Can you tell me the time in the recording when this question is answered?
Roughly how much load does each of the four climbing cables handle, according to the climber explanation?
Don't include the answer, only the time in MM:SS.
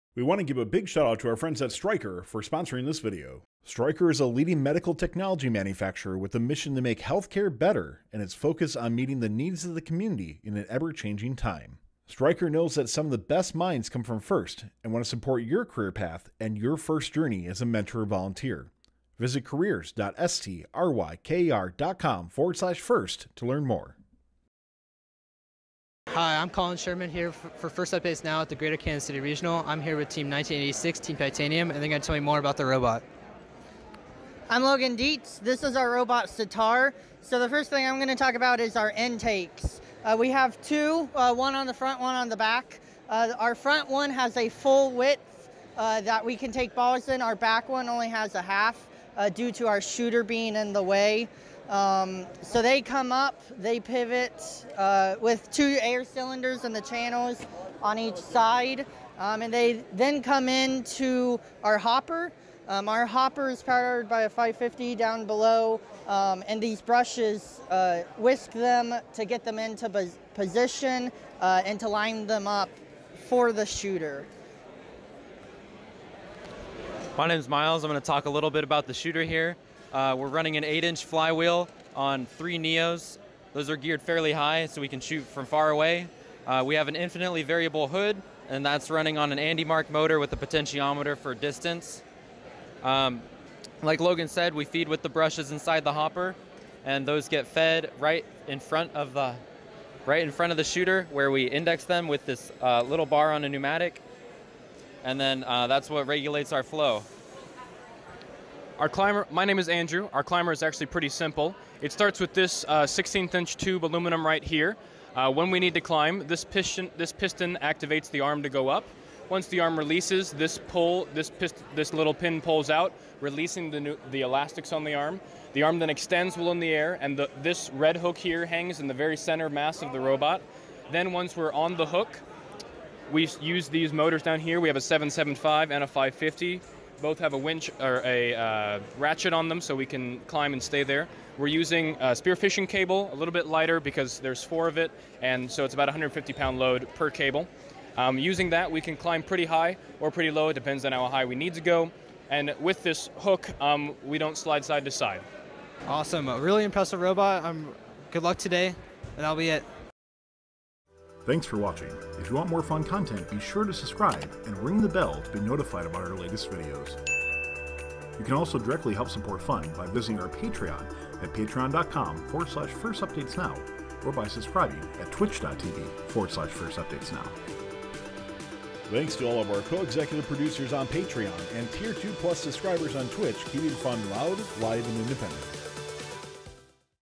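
02:25.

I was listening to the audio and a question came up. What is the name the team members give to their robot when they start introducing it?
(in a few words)
Sitar.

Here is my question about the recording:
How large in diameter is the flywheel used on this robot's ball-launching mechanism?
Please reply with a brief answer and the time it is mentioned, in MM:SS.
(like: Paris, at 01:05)
8-inch, at 01:20.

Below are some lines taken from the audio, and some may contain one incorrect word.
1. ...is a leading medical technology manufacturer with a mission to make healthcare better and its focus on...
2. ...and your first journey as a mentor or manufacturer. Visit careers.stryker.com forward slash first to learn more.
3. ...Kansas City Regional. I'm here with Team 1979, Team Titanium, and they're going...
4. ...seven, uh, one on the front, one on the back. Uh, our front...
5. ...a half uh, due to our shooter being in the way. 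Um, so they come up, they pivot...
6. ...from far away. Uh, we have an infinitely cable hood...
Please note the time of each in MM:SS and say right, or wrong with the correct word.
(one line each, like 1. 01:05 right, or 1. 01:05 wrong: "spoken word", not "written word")
1. 00:04 right
2. 00:16 wrong: "volunteer", not "manufacturer"
3. 00:28 wrong: "1986", not "1979"
4. 00:40 wrong: "two", not "seven"
5. 00:48 right
6. 01:25 wrong: "variable", not "cable".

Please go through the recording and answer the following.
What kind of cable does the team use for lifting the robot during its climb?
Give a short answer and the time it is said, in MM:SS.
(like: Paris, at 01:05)
spearfishing cable, at 02:22.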